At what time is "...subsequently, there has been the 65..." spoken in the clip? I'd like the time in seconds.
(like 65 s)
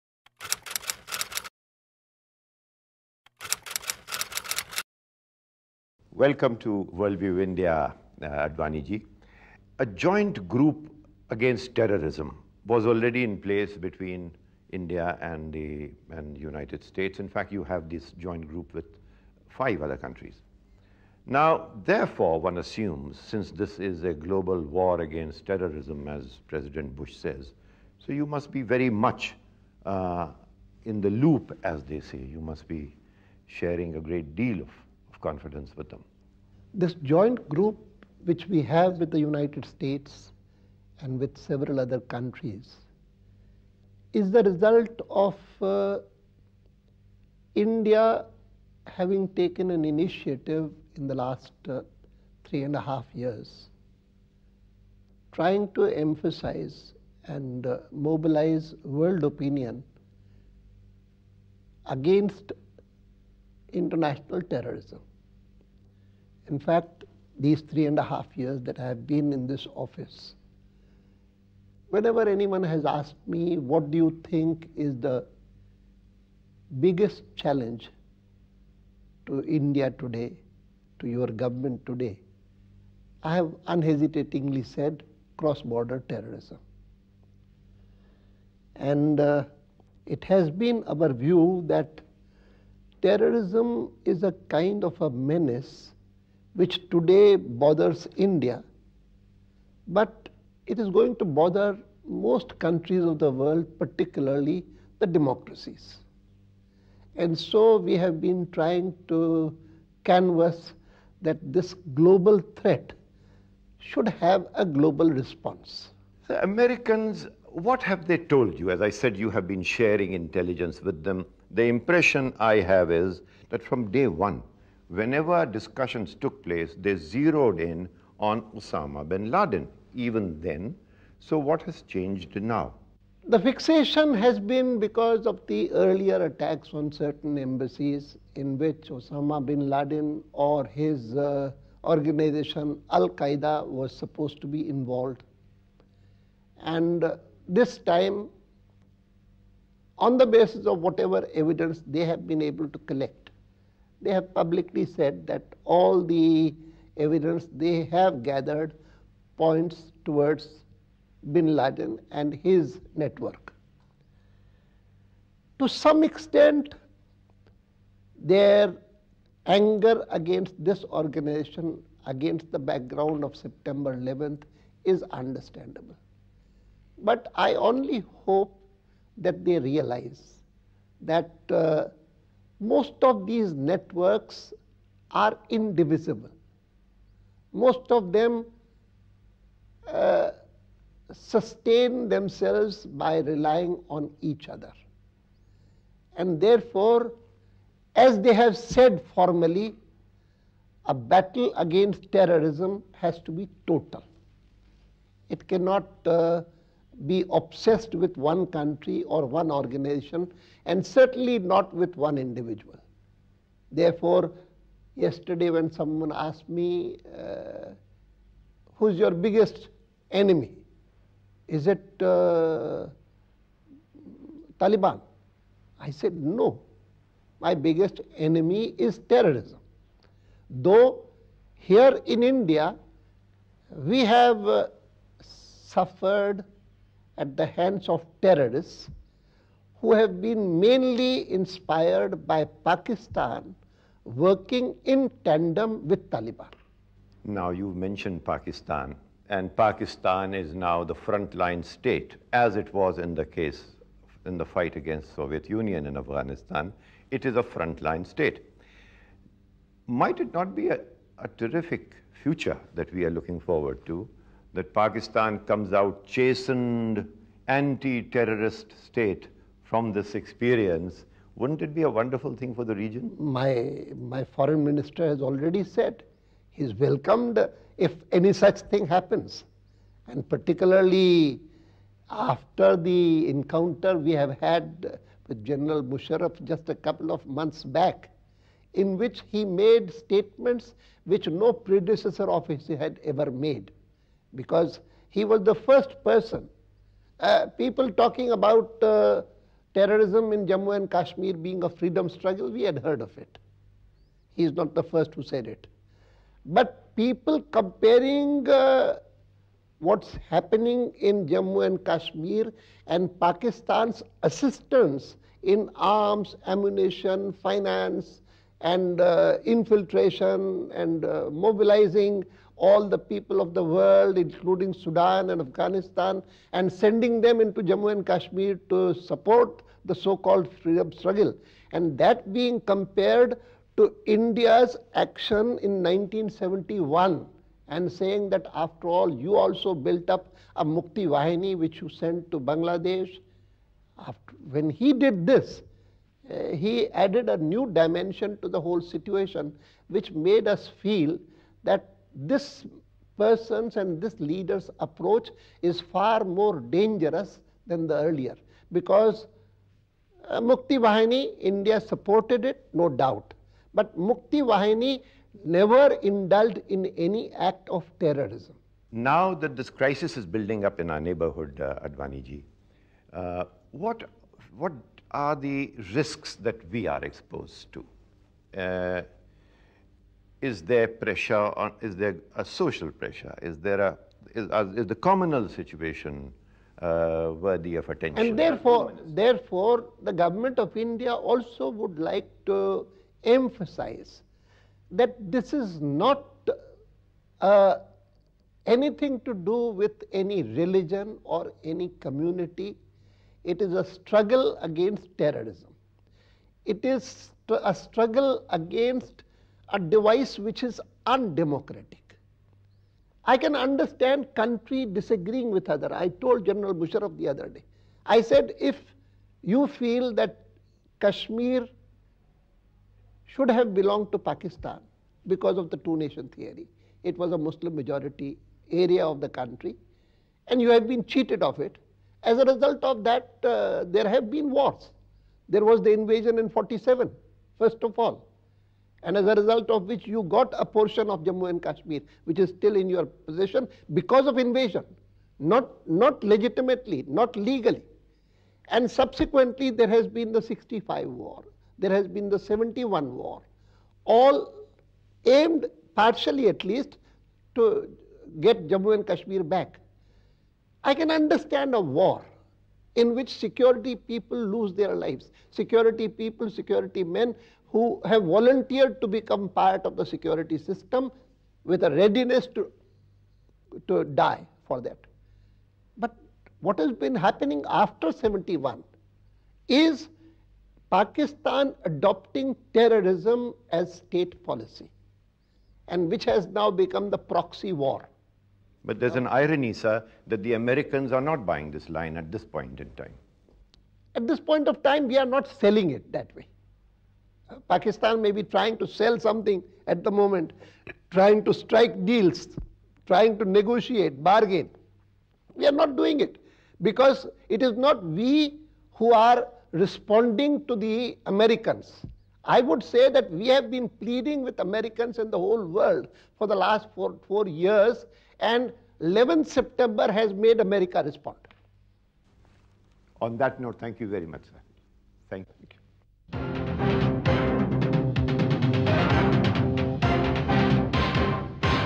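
448 s.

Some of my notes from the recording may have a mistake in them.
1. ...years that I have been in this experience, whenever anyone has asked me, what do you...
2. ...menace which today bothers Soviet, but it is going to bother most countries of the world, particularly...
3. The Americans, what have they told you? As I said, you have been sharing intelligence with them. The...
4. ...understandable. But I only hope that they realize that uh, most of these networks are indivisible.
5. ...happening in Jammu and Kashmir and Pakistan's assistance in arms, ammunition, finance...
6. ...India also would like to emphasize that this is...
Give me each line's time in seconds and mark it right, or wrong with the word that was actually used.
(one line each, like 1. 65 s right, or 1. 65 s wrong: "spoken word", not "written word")
1. 68 s wrong: "office", not "experience"
2. 95 s wrong: "India", not "Soviet"
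3. 116 s right
4. 175 s right
5. 310 s right
6. 390 s right.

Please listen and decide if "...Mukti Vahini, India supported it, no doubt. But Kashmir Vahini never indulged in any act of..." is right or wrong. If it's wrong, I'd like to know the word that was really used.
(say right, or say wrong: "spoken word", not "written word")
wrong: "Mukti", not "Kashmir".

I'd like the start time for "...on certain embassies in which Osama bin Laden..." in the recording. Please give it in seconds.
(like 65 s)
136 s.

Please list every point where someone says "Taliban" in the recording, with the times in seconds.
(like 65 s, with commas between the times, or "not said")
224 s, 246 s.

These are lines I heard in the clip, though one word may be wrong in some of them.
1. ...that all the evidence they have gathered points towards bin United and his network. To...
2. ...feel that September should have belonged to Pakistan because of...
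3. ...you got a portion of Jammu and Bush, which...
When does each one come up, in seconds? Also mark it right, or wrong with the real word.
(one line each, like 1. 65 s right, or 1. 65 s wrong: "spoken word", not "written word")
1. 155 s wrong: "Laden", not "United"
2. 419 s wrong: "Kashmir", not "September"
3. 440 s wrong: "Kashmir", not "Bush".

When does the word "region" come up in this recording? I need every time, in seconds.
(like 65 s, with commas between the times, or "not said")
272 s.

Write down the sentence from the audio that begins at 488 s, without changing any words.
But there's an irony, sir, that the Americans are not buying this line at this point in time.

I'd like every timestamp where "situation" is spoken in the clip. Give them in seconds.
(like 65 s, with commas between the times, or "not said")
348 s, 385 s.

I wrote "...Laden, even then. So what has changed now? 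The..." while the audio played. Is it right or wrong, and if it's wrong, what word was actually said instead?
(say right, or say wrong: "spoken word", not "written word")
right.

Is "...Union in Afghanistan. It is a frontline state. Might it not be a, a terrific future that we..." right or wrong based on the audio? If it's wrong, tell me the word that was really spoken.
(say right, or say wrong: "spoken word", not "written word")
right.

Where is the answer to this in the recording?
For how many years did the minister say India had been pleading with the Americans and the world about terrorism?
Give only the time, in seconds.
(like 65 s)
517 s.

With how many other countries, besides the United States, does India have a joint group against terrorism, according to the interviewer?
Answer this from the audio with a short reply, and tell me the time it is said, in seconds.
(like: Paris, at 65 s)
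5, at 19 s.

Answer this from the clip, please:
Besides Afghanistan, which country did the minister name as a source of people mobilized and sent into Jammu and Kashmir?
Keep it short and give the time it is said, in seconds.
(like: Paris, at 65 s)
Sudan, at 324 s.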